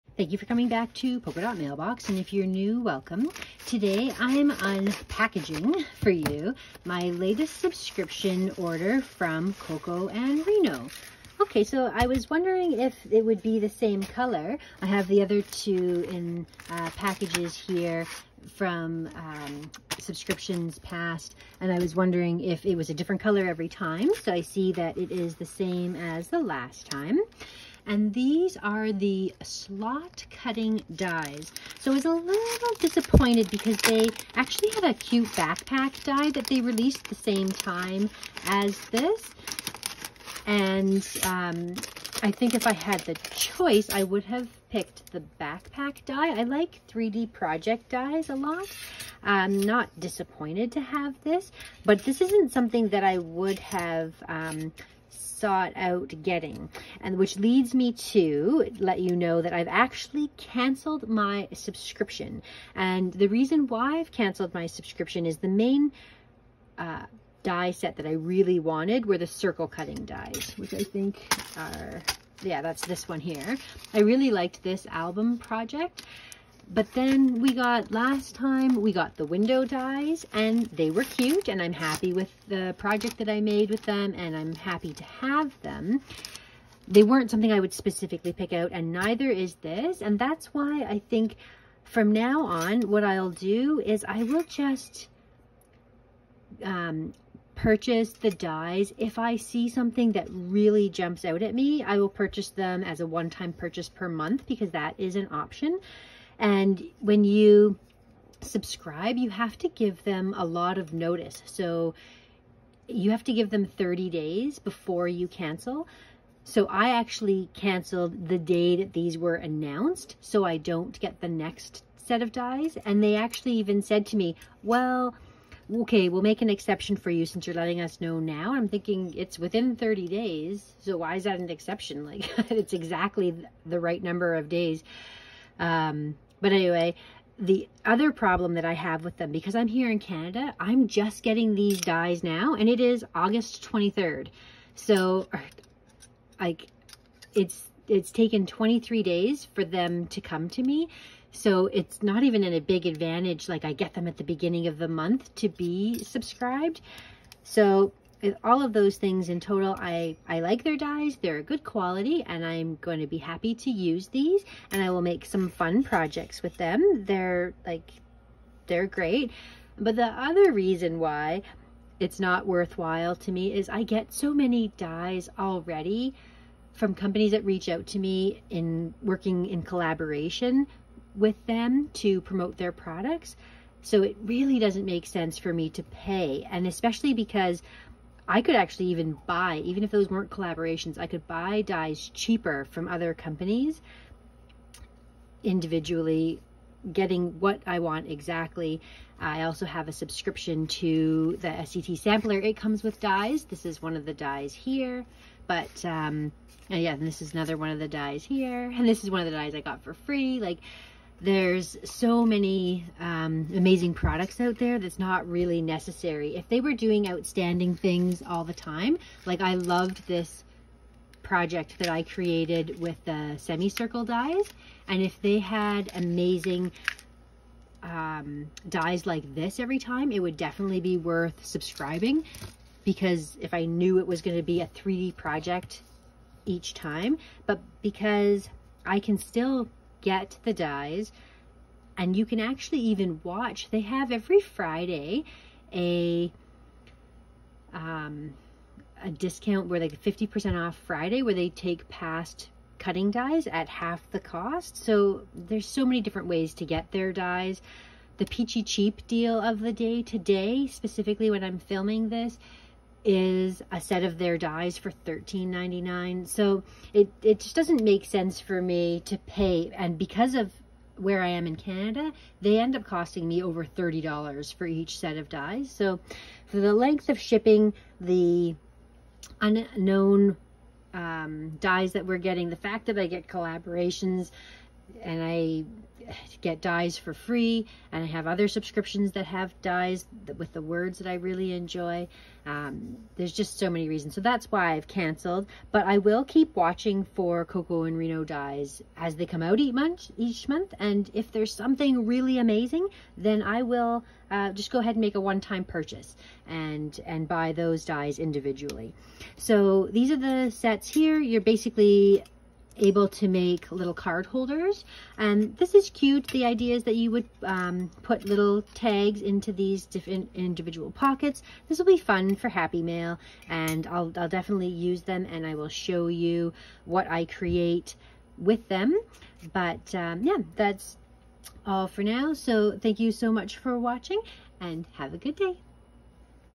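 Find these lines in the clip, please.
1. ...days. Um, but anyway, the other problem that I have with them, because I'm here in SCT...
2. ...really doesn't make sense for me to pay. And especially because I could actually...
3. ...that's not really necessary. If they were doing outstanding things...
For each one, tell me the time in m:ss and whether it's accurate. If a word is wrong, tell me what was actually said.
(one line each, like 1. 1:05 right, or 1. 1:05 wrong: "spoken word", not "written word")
1. 2:14 wrong: "Canada", not "SCT"
2. 3:04 right
3. 3:34 right.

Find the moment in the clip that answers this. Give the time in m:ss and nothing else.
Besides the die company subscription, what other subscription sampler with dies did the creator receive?
3:21.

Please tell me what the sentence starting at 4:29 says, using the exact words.
And because of where I am in Canada, they end up costing me over $30 for each set of dies.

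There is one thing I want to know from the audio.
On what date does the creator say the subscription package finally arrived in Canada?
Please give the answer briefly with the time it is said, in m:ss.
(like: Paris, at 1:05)
August 23rd, at 2:23.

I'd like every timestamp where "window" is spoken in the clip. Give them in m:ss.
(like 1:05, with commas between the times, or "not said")
1:19.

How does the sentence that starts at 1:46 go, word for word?
And when you subscribe, you have to give them a lot of notice.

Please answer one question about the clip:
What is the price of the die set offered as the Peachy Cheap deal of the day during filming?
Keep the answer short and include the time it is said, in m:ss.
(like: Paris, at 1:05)
$13.99, at 4:25.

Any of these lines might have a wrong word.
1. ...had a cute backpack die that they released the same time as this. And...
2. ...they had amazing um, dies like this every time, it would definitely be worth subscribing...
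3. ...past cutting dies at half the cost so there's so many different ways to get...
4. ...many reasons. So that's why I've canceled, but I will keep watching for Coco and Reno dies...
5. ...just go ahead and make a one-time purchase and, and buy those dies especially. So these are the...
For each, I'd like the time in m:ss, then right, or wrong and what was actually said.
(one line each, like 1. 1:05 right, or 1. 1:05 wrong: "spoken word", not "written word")
1. 0:34 right
2. 3:45 right
3. 4:11 right
4. 4:53 right
5. 5:04 wrong: "individually", not "especially".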